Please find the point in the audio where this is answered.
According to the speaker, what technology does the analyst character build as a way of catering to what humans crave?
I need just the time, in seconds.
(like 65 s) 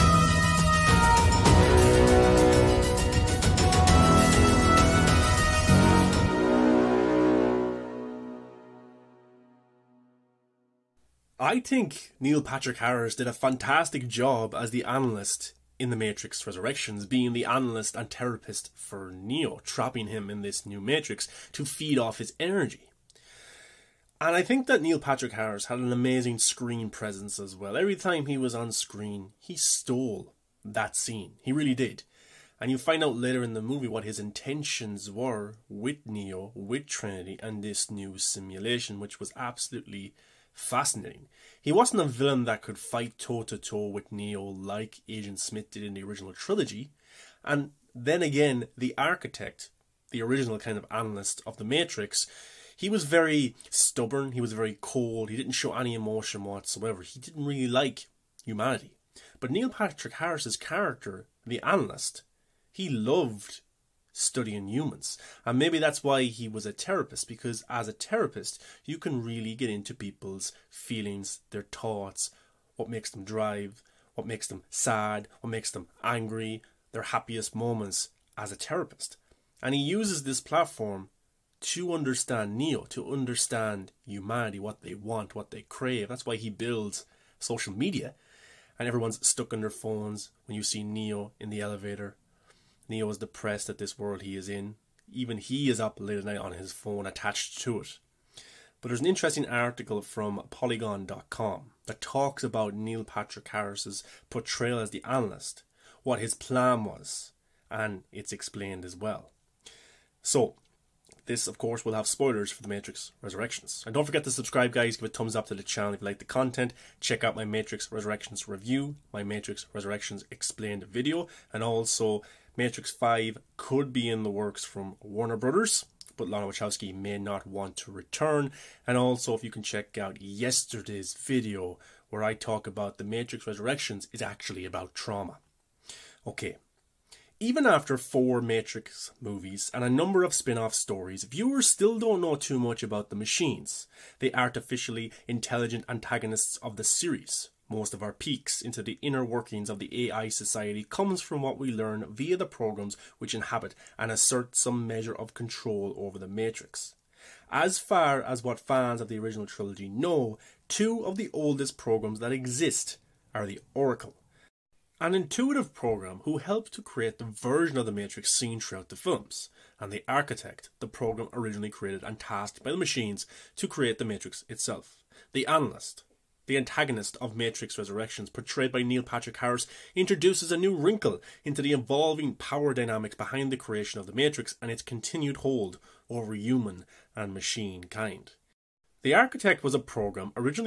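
87 s.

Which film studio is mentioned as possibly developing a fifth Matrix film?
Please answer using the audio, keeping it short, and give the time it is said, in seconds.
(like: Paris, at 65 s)
Warner Brothers, at 125 s.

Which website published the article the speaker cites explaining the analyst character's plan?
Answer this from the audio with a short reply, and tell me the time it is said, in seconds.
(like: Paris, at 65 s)
Polygon.com, at 100 s.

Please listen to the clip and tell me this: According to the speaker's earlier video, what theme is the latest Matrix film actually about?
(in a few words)
Trauma.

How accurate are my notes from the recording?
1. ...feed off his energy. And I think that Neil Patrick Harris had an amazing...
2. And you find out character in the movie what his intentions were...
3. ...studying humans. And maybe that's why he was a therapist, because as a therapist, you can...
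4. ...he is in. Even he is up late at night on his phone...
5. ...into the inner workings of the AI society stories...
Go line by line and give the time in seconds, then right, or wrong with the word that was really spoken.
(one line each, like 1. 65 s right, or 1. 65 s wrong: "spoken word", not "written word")
1. 21 s right
2. 32 s wrong: "later", not "character"
3. 64 s right
4. 94 s right
5. 148 s wrong: "comes", not "stories".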